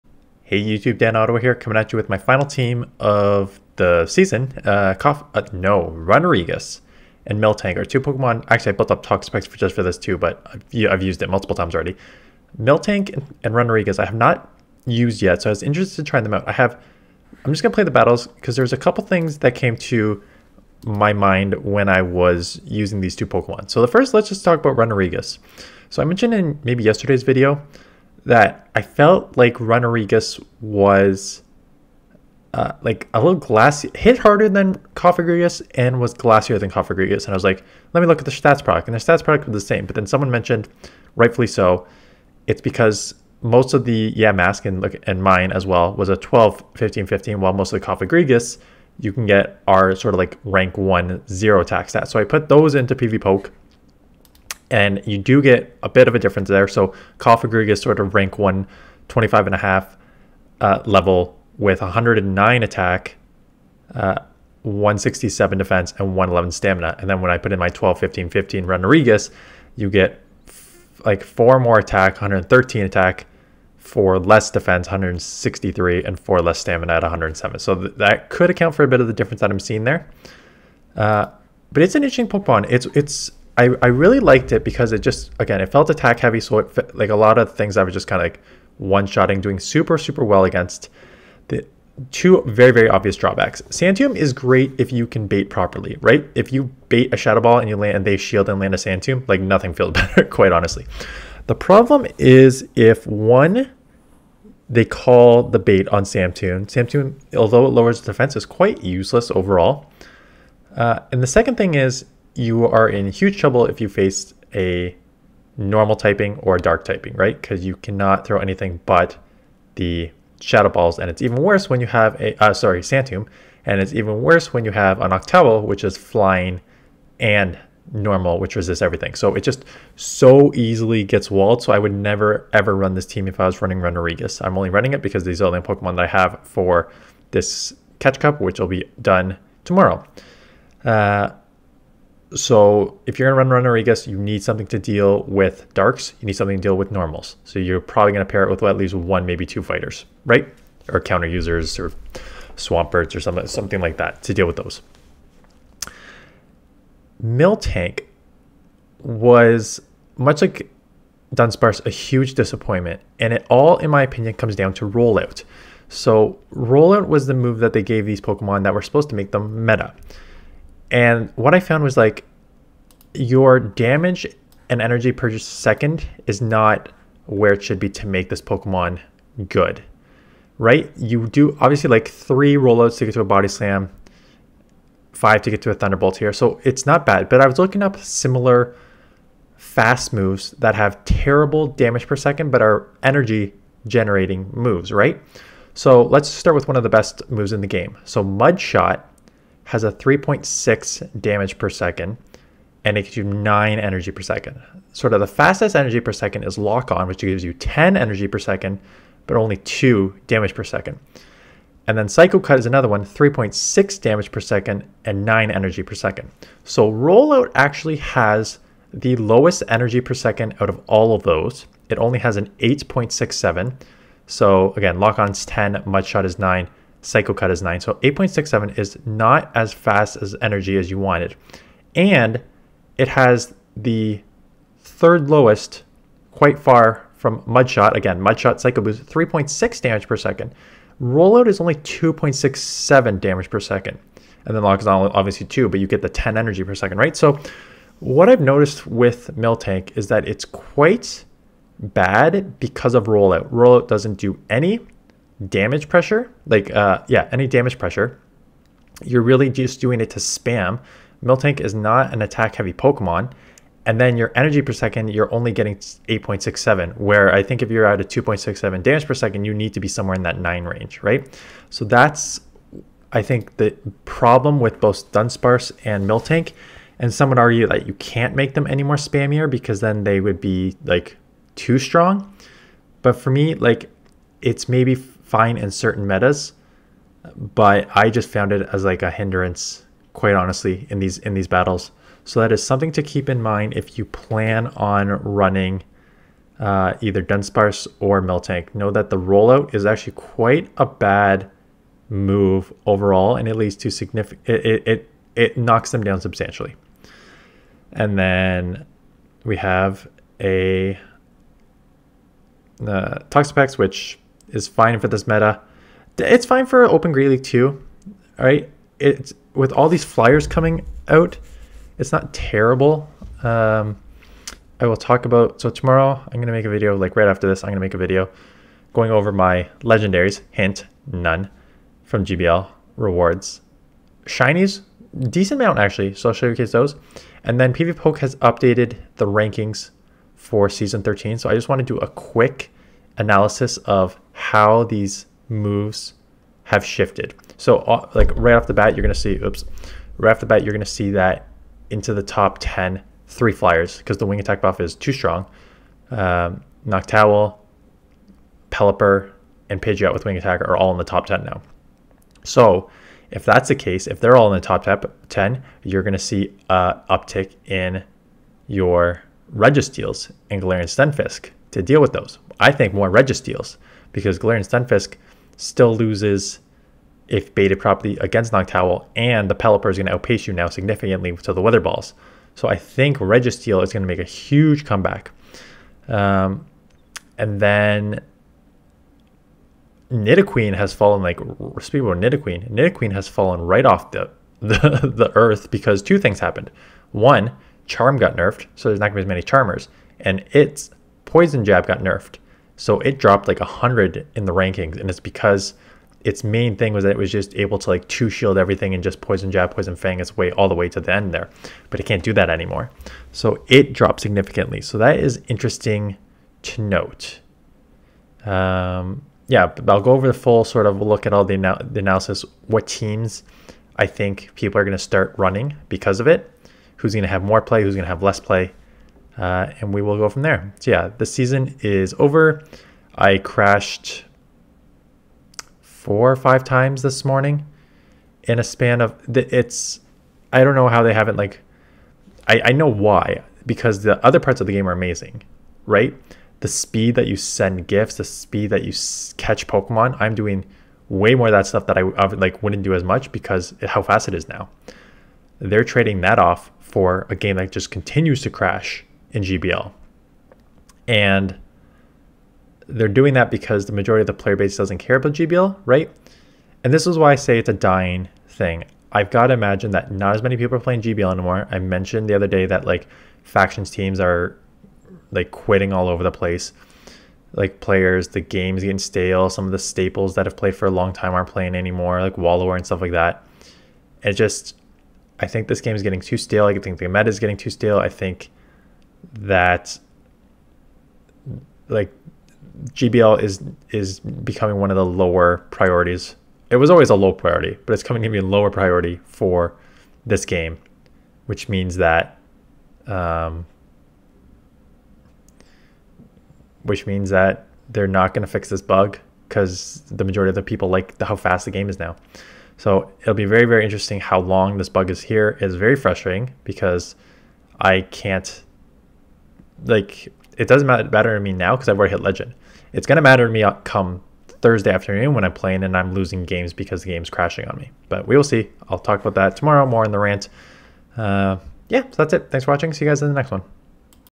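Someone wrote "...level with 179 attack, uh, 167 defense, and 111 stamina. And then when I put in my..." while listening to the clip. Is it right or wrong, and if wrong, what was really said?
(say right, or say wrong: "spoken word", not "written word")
wrong: "109", not "179".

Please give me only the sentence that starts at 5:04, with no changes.
It, it it knocks them down substantially.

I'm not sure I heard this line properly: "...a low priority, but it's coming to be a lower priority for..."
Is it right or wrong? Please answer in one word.
right.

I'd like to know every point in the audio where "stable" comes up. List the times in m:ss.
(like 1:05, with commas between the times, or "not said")
not said.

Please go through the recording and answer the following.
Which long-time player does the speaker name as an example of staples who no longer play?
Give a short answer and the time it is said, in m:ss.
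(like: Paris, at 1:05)
Wallower, at 8:02.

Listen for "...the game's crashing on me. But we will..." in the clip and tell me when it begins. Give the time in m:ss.
8:47.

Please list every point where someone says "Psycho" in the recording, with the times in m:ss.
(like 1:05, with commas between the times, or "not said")
3:32, 3:47, 3:58.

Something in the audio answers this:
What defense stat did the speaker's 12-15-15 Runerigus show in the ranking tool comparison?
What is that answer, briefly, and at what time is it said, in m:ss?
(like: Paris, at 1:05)
163, at 1:14.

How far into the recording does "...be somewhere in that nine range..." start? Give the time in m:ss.
4:29.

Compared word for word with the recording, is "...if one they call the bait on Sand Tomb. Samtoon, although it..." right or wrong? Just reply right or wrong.
right.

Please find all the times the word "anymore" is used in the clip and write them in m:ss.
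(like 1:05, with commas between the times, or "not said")
6:52, 7:51, 8:01.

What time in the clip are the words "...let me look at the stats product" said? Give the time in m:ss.
0:37.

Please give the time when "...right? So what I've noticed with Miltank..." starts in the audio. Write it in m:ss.
4:06.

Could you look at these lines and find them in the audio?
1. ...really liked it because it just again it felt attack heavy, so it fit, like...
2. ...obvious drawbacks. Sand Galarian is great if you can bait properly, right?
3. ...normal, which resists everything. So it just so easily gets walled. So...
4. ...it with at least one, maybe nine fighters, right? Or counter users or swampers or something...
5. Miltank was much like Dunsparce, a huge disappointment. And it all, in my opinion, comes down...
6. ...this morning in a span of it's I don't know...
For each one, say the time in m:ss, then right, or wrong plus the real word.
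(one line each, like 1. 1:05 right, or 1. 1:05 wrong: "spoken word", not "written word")
1. 1:23 right
2. 1:32 wrong: "Tomb", not "Galarian"
3. 2:07 right
4. 2:28 wrong: "two", not "nine"
5. 2:37 right
6. 7:17 right.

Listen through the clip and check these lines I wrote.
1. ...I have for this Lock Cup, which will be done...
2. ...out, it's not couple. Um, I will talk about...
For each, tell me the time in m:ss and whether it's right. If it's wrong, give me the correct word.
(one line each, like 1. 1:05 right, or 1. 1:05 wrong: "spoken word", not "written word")
1. 2:16 wrong: "Catch", not "Lock"
2. 5:21 wrong: "terrible", not "couple".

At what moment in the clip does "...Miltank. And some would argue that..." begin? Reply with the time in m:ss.
4:36.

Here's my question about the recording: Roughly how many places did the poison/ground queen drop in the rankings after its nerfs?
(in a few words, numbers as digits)
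100.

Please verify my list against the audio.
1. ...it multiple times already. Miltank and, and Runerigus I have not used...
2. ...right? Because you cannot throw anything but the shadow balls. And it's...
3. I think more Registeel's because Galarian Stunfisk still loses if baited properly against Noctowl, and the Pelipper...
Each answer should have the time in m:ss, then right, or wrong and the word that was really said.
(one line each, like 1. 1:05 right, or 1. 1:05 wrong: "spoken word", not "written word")
1. 0:11 right
2. 1:57 right
3. 6:12 right.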